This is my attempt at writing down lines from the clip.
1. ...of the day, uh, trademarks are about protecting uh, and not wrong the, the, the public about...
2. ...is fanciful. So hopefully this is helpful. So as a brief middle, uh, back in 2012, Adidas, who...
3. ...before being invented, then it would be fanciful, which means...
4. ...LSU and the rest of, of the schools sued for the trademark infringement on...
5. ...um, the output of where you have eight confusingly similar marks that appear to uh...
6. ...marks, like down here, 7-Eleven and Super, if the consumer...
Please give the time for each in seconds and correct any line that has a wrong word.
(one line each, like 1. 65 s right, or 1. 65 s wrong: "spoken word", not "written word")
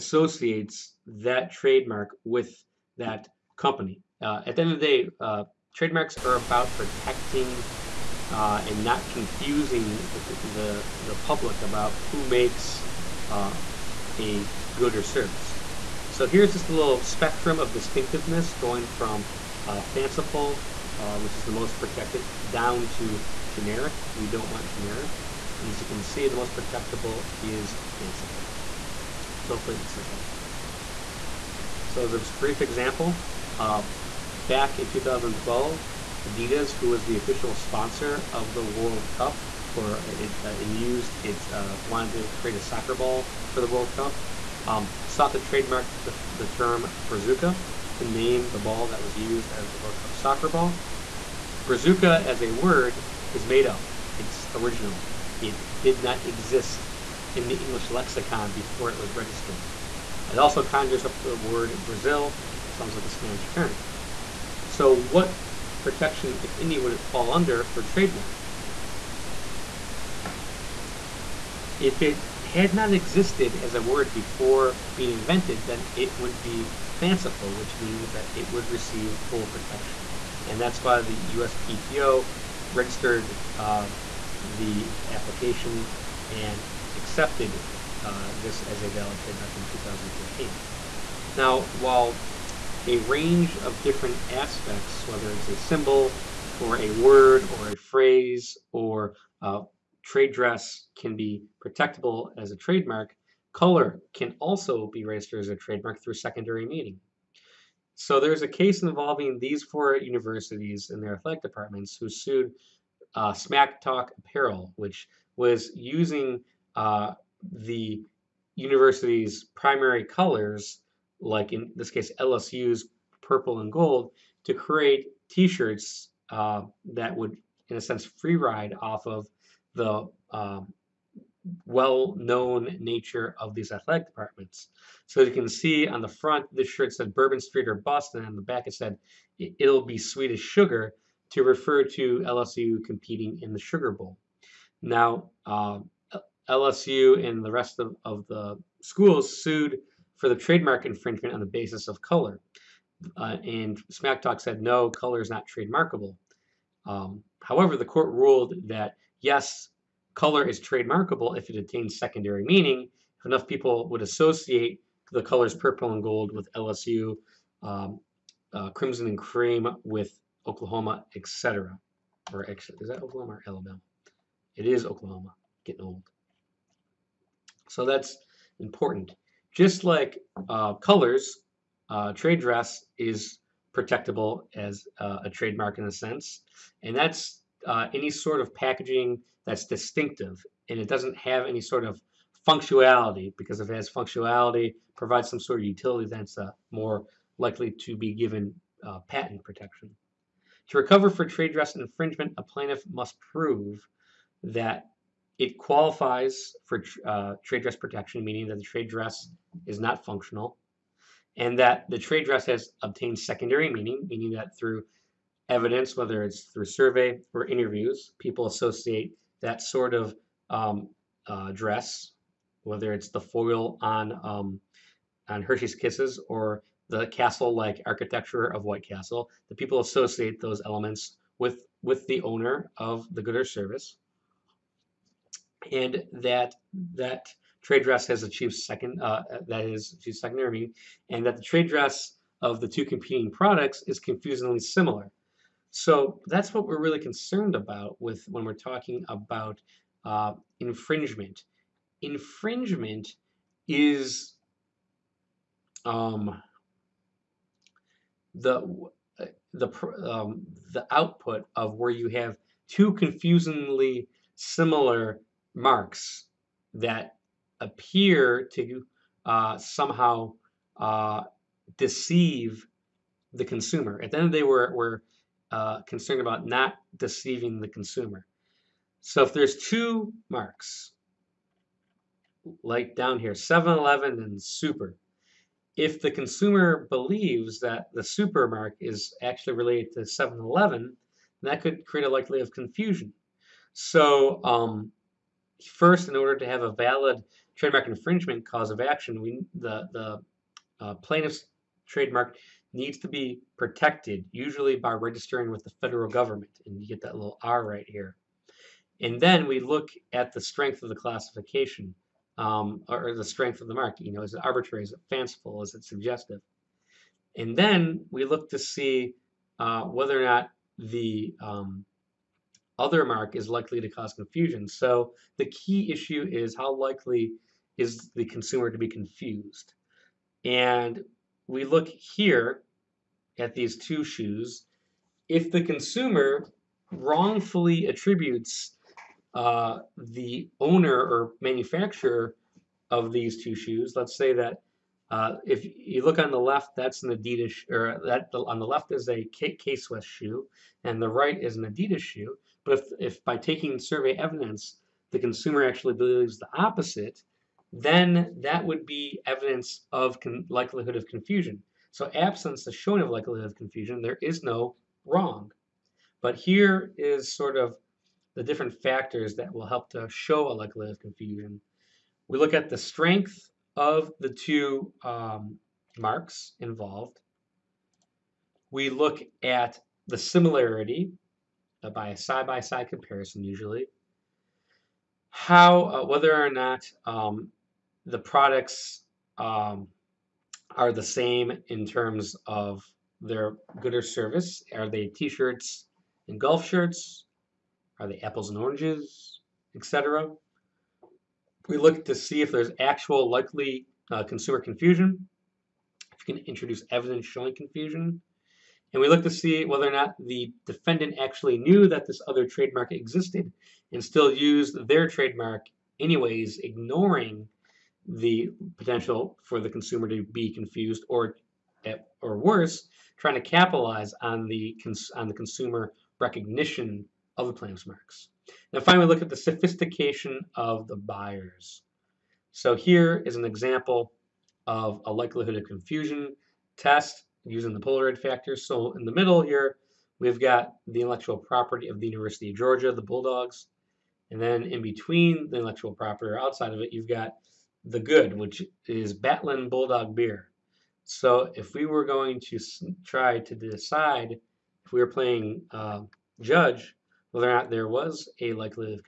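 1. 4 s wrong: "confusing", not "wrong"
2. 27 s wrong: "example", not "middle"
3. 74 s right
4. 146 s right
5. 260 s wrong: "two", not "eight"
6. 280 s right.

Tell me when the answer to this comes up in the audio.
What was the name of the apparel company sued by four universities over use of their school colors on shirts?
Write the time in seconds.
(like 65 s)
113 s.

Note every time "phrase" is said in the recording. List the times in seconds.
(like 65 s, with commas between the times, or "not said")
97 s.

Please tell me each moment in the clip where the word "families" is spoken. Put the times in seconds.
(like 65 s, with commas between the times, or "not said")
not said.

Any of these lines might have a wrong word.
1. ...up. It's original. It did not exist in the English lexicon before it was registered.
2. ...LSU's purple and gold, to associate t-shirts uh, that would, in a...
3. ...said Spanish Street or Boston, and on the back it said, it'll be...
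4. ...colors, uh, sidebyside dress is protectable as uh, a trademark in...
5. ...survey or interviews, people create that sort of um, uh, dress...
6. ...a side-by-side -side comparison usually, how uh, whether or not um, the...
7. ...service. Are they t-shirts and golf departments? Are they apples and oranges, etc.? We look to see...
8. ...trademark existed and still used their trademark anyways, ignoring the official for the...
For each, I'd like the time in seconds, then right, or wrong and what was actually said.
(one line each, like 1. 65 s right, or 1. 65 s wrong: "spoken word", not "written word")
1. 53 s right
2. 122 s wrong: "create", not "associate"
3. 136 s wrong: "Bourbon", not "Spanish"
4. 180 s wrong: "trade", not "sidebyside"
5. 216 s wrong: "associate", not "create"
6. 382 s right
7. 394 s wrong: "shirts", not "departments"
8. 412 s wrong: "potential", not "official".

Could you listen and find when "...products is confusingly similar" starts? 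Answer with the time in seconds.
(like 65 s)
243 s.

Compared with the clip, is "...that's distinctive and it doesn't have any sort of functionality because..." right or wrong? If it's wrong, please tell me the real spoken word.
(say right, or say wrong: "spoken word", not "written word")
right.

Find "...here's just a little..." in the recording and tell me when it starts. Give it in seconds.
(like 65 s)
16 s.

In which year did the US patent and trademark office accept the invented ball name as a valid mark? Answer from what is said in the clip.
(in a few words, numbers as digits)
2013.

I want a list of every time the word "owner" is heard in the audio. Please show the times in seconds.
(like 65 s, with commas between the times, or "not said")
232 s, 340 s.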